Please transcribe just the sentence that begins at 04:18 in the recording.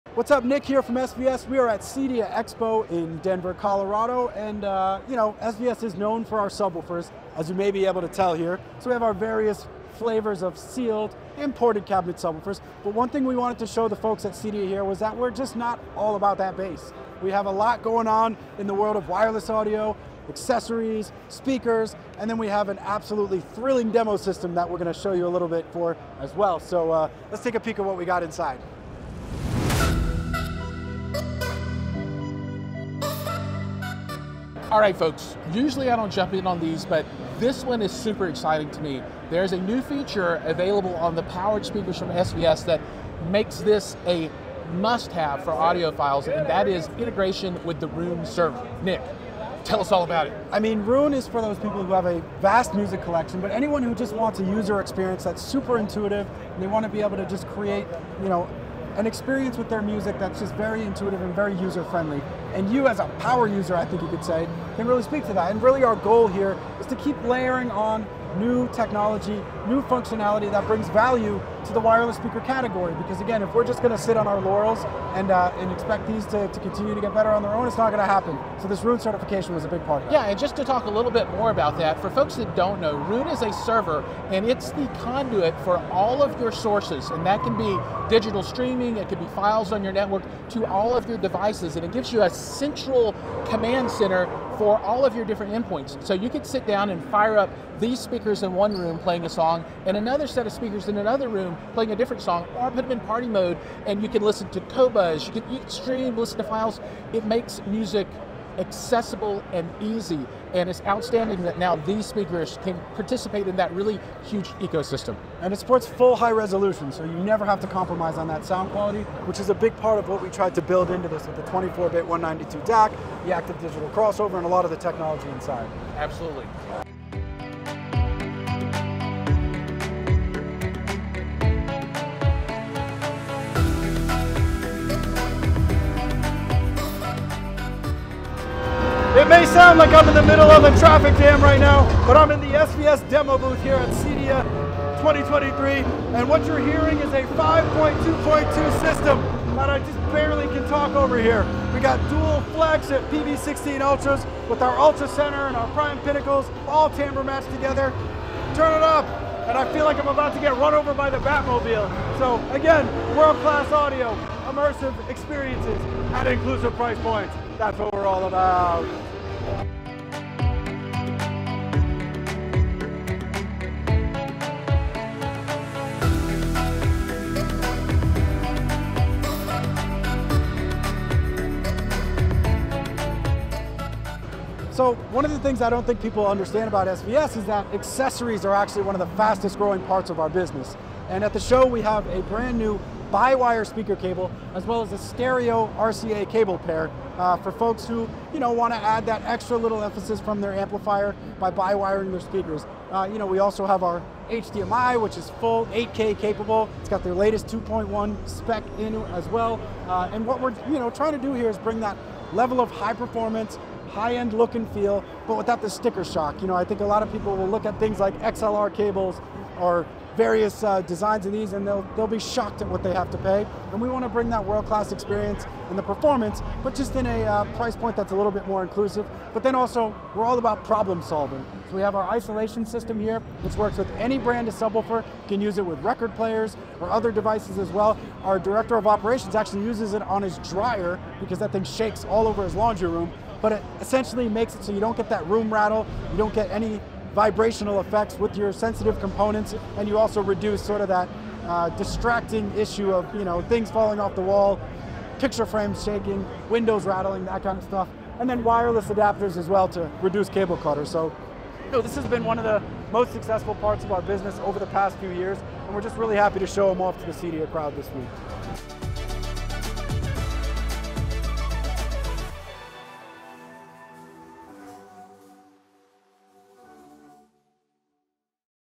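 And then wireless adapters as well to reduce cable clutter.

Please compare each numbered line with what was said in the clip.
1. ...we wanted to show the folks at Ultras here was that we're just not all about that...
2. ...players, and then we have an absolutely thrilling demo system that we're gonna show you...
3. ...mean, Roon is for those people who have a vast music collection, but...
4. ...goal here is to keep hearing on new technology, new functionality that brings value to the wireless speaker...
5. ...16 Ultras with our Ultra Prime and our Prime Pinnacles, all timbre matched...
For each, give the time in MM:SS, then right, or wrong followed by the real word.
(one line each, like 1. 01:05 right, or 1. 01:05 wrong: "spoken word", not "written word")
1. 00:13 wrong: "CEDIA", not "Ultras"
2. 00:21 wrong: "speakers", not "players"
3. 00:50 right
4. 01:05 wrong: "layering", not "hearing"
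5. 02:33 wrong: "Center", not "Prime".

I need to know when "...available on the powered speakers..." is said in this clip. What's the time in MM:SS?
00:40.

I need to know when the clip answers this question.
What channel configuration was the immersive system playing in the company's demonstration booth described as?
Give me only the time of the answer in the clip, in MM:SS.
02:27.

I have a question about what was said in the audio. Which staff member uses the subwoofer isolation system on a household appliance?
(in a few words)
Director of operations.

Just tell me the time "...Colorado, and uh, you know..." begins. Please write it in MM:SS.
00:03.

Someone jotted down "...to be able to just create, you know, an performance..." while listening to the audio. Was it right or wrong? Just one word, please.
wrong.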